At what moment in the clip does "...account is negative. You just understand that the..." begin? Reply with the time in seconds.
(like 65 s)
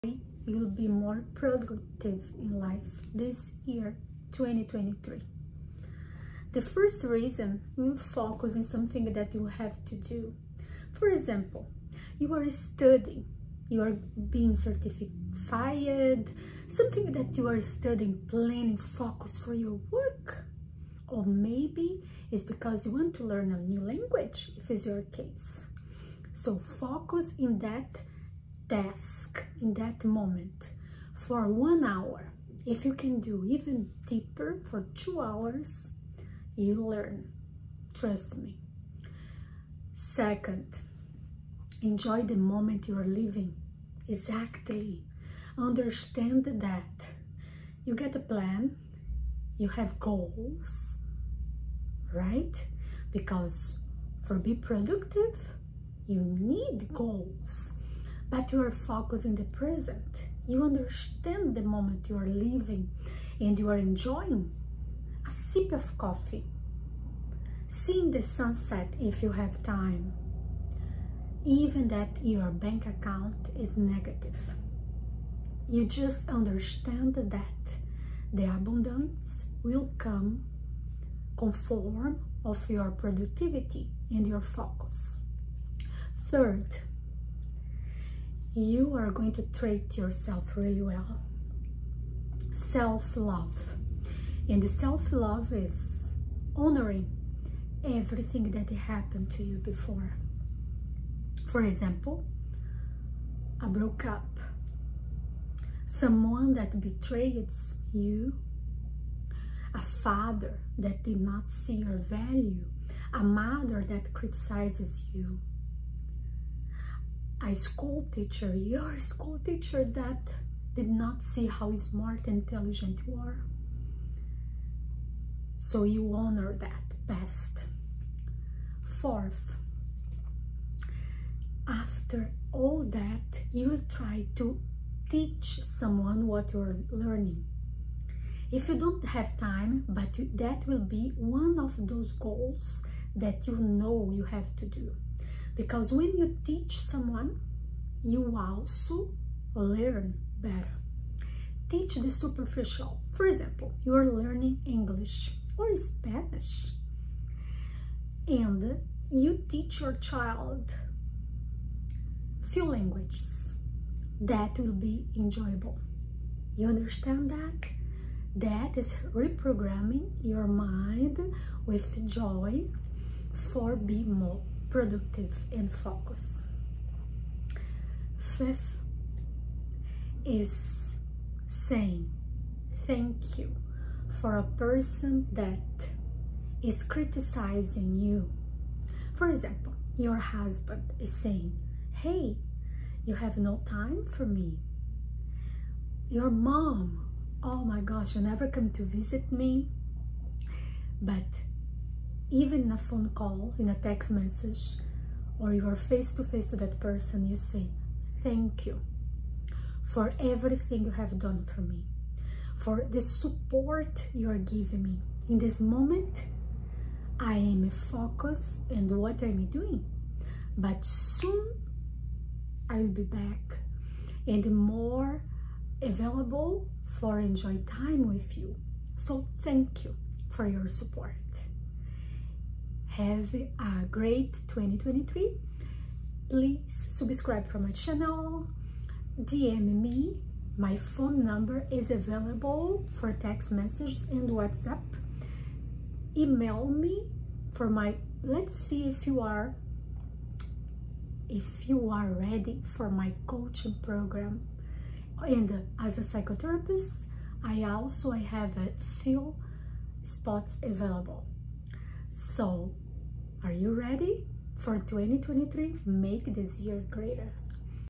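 72 s.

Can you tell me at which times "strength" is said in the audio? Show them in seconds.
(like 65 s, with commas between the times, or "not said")
not said.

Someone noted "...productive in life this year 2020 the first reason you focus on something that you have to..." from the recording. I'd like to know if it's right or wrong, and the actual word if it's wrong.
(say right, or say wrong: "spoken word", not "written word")
wrong: "2023", not "2020".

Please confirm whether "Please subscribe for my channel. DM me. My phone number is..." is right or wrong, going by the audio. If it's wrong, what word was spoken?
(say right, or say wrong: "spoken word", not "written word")
right.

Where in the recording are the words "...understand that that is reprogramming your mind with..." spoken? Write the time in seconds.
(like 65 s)
166 s.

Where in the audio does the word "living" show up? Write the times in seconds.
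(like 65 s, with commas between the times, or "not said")
43 s, 62 s.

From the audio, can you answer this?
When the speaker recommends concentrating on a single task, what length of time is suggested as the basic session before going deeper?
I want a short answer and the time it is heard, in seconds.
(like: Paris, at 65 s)
1 hour, at 31 s.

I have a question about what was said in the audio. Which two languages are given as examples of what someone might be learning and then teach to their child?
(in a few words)
English or Spanish.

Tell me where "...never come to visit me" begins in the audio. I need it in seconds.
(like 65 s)
198 s.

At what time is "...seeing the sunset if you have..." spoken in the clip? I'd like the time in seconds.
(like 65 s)
67 s.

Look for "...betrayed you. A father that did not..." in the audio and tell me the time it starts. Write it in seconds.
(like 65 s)
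106 s.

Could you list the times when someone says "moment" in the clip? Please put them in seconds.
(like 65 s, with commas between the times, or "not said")
30 s, 42 s, 61 s, 215 s.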